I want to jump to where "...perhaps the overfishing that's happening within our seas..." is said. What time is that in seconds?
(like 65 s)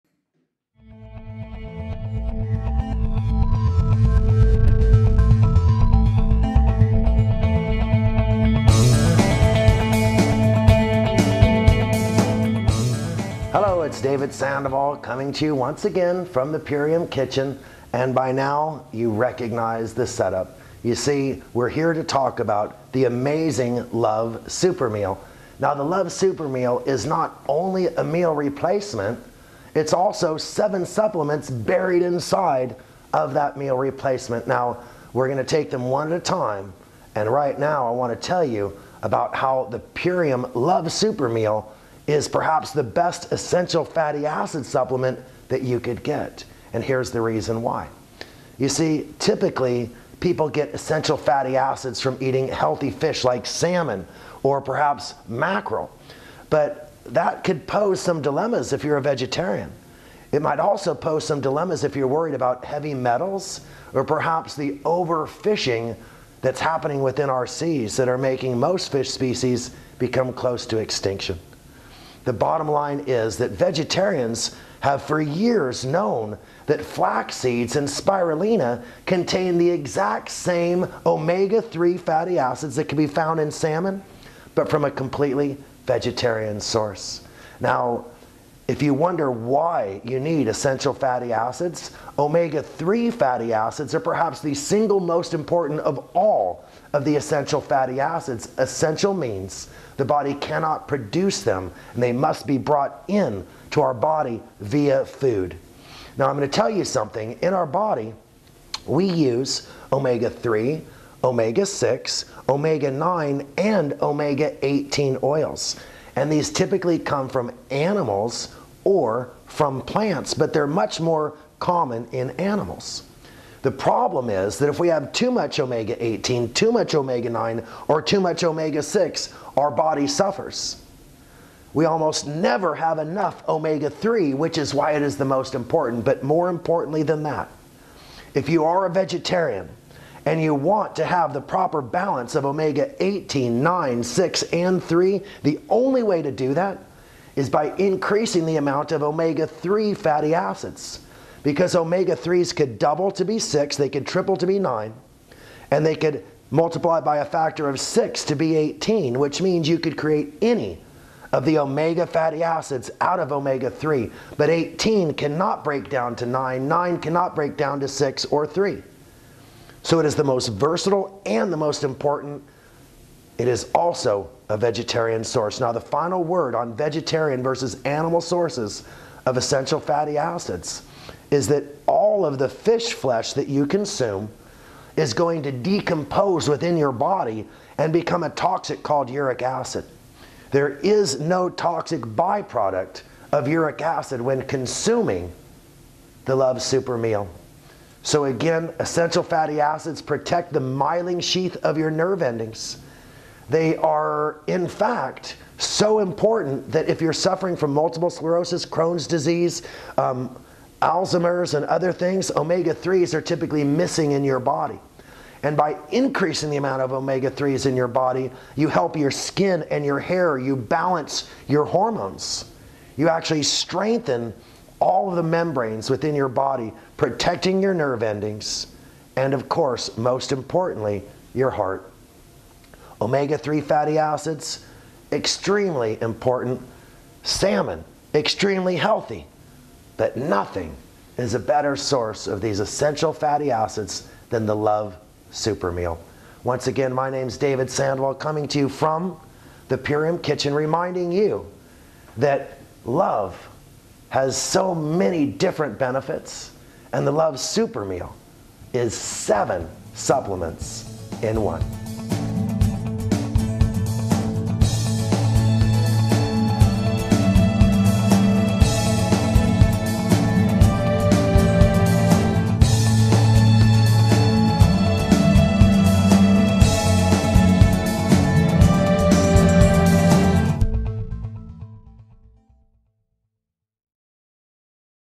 64 s.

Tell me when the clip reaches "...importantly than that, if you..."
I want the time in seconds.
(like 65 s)
136 s.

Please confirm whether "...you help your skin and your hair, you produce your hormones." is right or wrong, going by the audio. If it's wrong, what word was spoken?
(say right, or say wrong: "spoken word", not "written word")
wrong: "balance", not "produce".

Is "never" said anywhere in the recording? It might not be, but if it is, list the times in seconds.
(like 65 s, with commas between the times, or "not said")
132 s.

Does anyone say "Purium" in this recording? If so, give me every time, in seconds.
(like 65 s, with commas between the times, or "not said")
16 s, 39 s, 249 s.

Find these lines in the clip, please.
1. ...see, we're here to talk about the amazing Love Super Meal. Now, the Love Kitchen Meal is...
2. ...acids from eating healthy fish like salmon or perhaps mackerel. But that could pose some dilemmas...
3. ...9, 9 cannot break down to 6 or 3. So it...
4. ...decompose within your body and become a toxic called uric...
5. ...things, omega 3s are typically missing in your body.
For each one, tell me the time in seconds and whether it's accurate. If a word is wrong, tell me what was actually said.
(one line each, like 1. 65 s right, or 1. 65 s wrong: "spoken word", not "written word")
1. 20 s wrong: "Super", not "Kitchen"
2. 51 s right
3. 166 s right
4. 185 s right
5. 211 s right.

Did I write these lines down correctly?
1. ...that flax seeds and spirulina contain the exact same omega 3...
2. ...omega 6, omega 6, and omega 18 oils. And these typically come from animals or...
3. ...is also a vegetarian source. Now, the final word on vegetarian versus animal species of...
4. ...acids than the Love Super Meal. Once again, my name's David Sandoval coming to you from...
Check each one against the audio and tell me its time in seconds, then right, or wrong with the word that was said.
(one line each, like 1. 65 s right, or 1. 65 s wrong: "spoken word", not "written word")
1. 76 s right
2. 111 s wrong: "9", not "6"
3. 173 s wrong: "sources", not "species"
4. 243 s right.